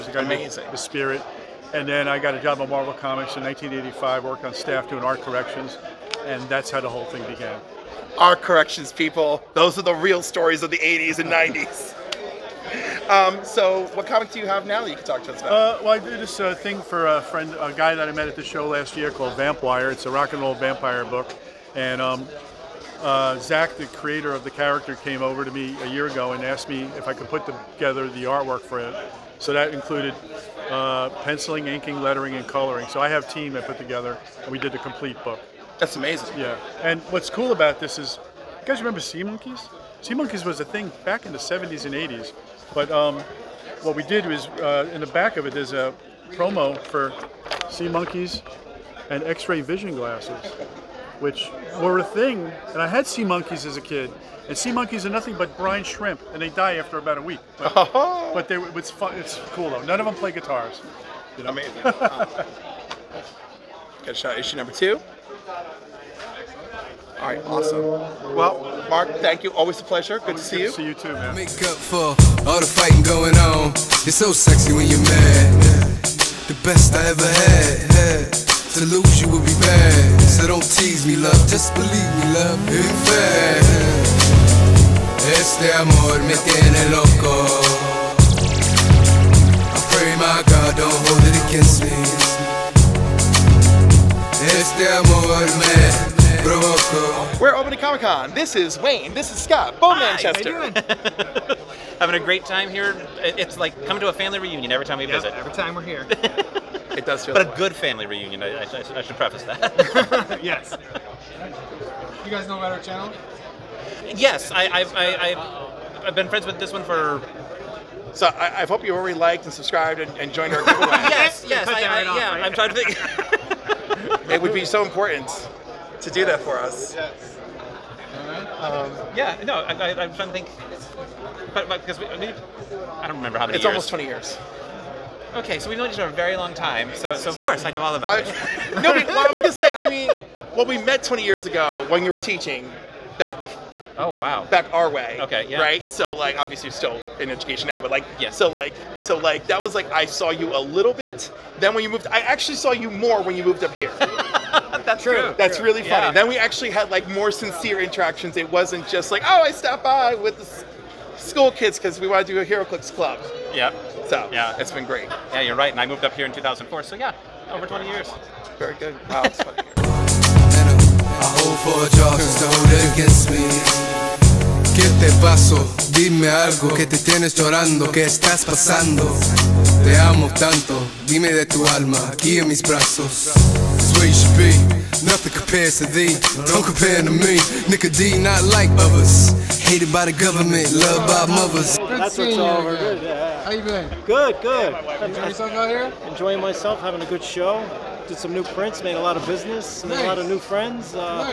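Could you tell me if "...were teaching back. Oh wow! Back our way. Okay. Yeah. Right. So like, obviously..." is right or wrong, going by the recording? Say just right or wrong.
right.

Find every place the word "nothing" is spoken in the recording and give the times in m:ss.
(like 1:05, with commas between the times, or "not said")
0:55, 3:05.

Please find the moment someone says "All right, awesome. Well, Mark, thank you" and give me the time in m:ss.
1:07.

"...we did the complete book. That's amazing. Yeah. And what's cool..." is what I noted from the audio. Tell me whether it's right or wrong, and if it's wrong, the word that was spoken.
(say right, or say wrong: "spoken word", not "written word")
right.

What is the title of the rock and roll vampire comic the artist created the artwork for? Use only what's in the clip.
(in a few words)
Vampwire.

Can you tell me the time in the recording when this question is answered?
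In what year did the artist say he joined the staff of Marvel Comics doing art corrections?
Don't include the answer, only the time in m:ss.
0:03.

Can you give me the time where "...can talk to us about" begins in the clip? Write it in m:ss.
0:14.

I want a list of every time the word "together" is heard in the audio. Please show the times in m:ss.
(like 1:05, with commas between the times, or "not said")
0:27, 0:33.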